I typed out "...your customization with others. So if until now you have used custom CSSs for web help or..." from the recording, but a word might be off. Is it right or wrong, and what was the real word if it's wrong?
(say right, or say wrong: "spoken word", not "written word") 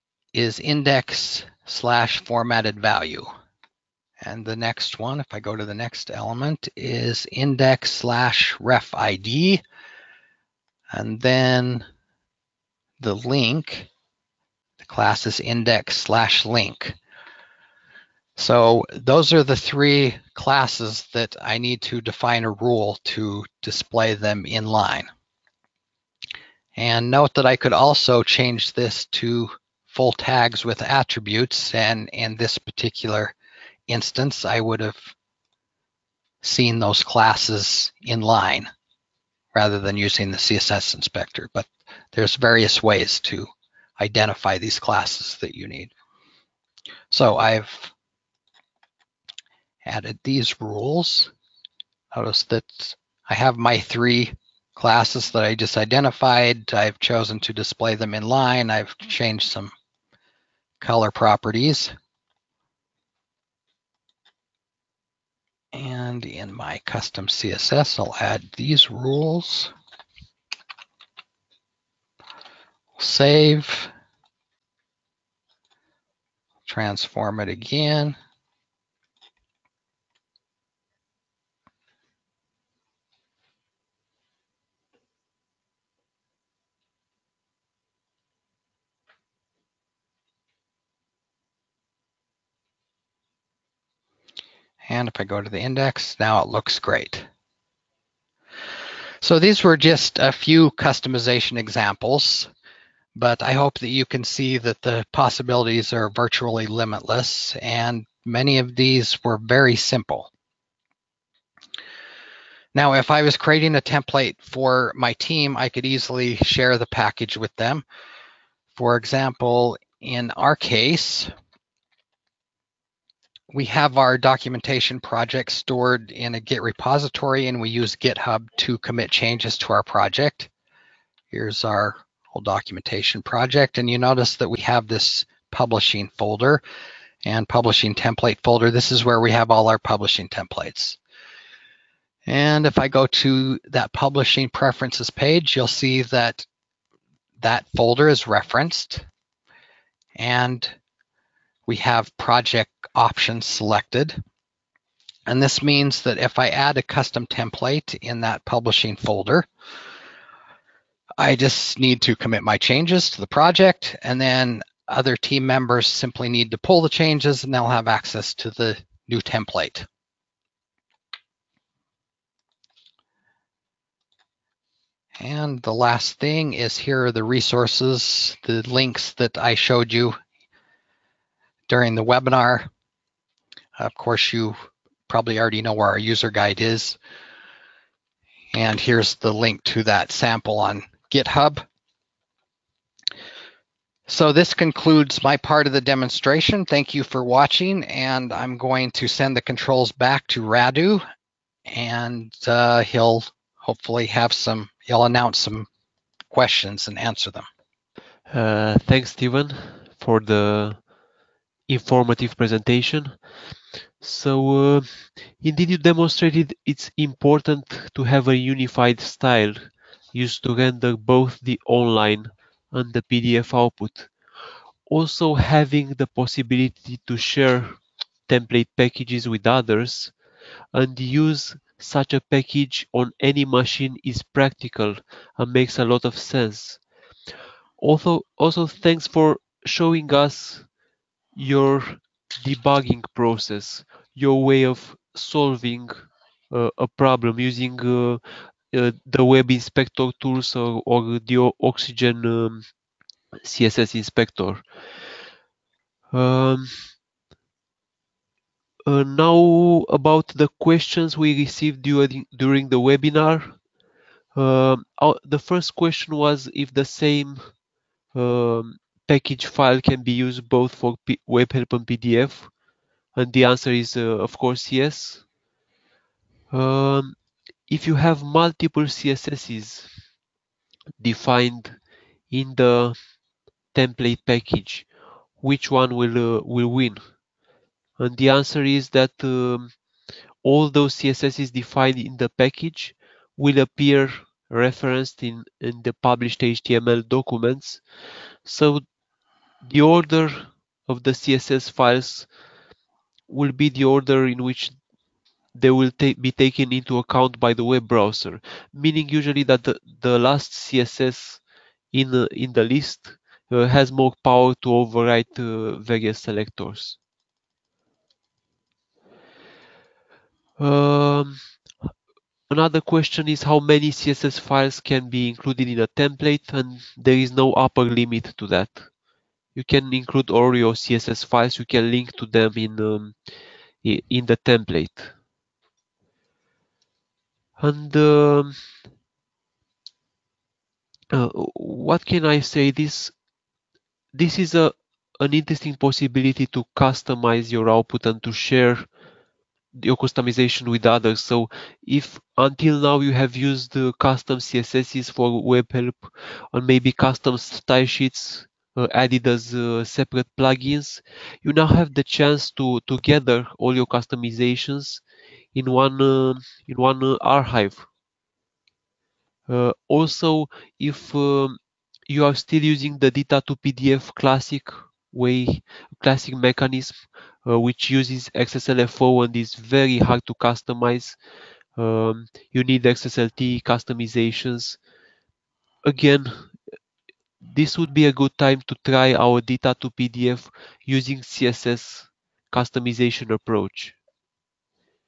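right.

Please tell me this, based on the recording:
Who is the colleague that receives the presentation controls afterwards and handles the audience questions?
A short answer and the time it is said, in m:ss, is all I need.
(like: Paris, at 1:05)
Radu, at 3:20.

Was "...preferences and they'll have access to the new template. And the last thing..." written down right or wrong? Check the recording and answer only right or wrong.
wrong.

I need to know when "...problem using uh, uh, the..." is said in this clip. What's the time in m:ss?
4:06.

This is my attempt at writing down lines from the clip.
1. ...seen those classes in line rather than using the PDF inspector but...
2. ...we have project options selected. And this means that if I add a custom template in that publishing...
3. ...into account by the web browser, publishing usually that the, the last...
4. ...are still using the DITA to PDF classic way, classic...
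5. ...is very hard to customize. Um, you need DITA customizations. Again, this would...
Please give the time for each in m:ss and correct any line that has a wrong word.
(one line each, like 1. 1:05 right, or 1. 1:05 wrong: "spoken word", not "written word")
1. 0:36 wrong: "CSS", not "PDF"
2. 2:31 right
3. 5:06 wrong: "meaning", not "publishing"
4. 6:12 right
5. 6:19 wrong: "XSLT", not "DITA".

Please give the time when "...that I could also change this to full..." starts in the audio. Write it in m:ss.
0:27.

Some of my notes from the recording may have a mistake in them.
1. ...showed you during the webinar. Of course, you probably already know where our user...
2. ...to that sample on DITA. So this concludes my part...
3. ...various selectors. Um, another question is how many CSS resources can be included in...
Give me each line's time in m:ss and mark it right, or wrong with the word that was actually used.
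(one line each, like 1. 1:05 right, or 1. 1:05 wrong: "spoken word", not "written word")
1. 2:59 right
2. 3:09 wrong: "GitHub", not "DITA"
3. 5:15 wrong: "files", not "resources".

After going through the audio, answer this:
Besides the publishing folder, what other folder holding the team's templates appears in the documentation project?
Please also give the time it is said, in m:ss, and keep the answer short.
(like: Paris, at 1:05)
publishing template folder, at 2:17.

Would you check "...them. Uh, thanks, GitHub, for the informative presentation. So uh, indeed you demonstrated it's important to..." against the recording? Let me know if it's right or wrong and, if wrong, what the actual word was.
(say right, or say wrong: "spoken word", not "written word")
wrong: "Steven", not "GitHub".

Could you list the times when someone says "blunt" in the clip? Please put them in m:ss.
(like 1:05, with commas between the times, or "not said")
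not said.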